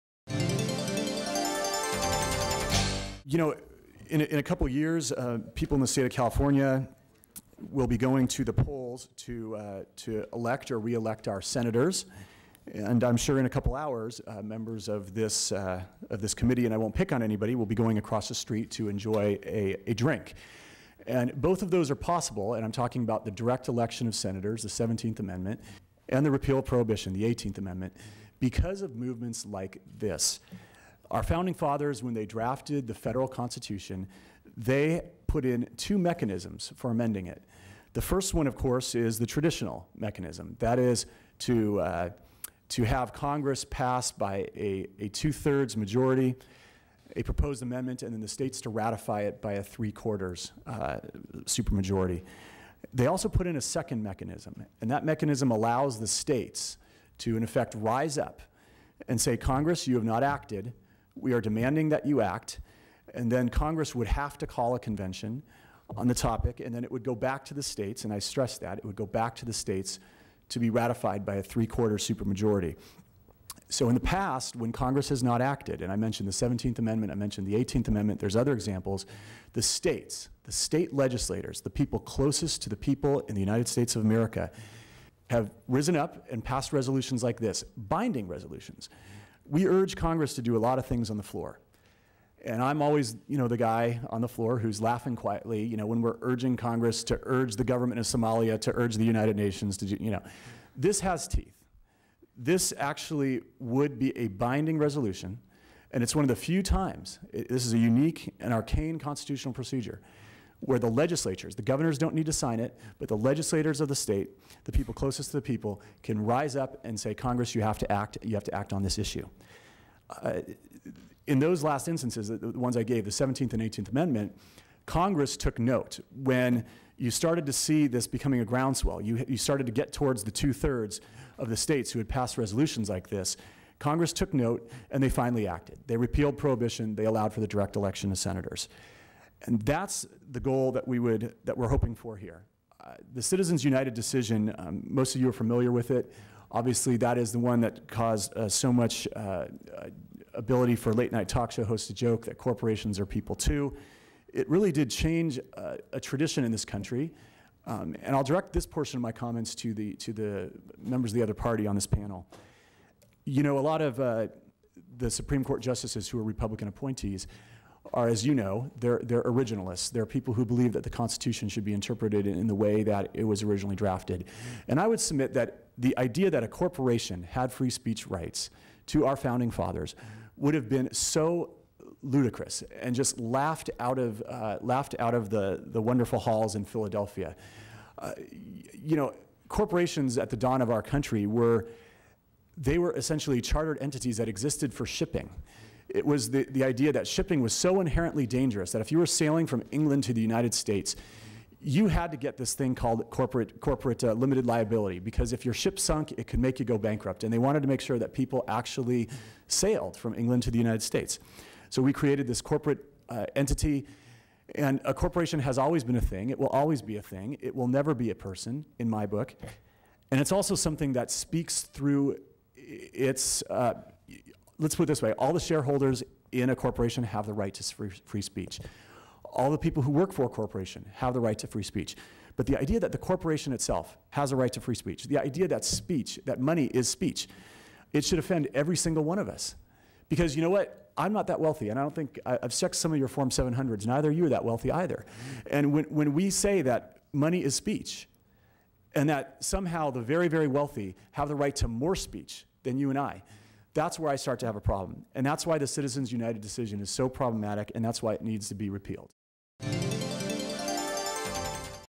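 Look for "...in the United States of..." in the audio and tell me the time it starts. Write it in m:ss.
1:23.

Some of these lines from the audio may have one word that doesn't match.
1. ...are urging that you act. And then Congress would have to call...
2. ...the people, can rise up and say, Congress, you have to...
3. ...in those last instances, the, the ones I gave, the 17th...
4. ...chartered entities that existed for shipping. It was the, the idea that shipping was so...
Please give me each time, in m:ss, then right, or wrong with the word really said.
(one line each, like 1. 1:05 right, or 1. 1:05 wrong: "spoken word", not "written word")
1. 1:01 wrong: "demanding", not "urging"
2. 1:55 right
3. 2:01 right
4. 3:13 right.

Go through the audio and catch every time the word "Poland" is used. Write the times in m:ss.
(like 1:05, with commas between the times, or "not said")
not said.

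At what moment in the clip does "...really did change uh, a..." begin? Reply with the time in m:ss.
2:34.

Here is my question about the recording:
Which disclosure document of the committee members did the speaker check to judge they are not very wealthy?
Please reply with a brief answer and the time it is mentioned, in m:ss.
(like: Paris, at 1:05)
Form 700, at 4:03.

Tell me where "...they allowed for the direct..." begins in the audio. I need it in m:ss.
2:16.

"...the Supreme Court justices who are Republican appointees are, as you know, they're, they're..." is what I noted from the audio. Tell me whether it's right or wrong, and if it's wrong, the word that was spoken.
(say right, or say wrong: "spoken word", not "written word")
right.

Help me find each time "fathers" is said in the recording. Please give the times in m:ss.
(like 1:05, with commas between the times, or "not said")
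0:31, 2:59.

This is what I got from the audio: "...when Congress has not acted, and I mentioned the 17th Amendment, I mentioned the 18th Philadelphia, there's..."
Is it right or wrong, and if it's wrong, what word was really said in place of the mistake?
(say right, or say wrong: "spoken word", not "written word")
wrong: "Amendment", not "Philadelphia".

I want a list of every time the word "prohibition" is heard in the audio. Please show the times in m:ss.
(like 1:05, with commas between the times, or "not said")
0:26, 2:16.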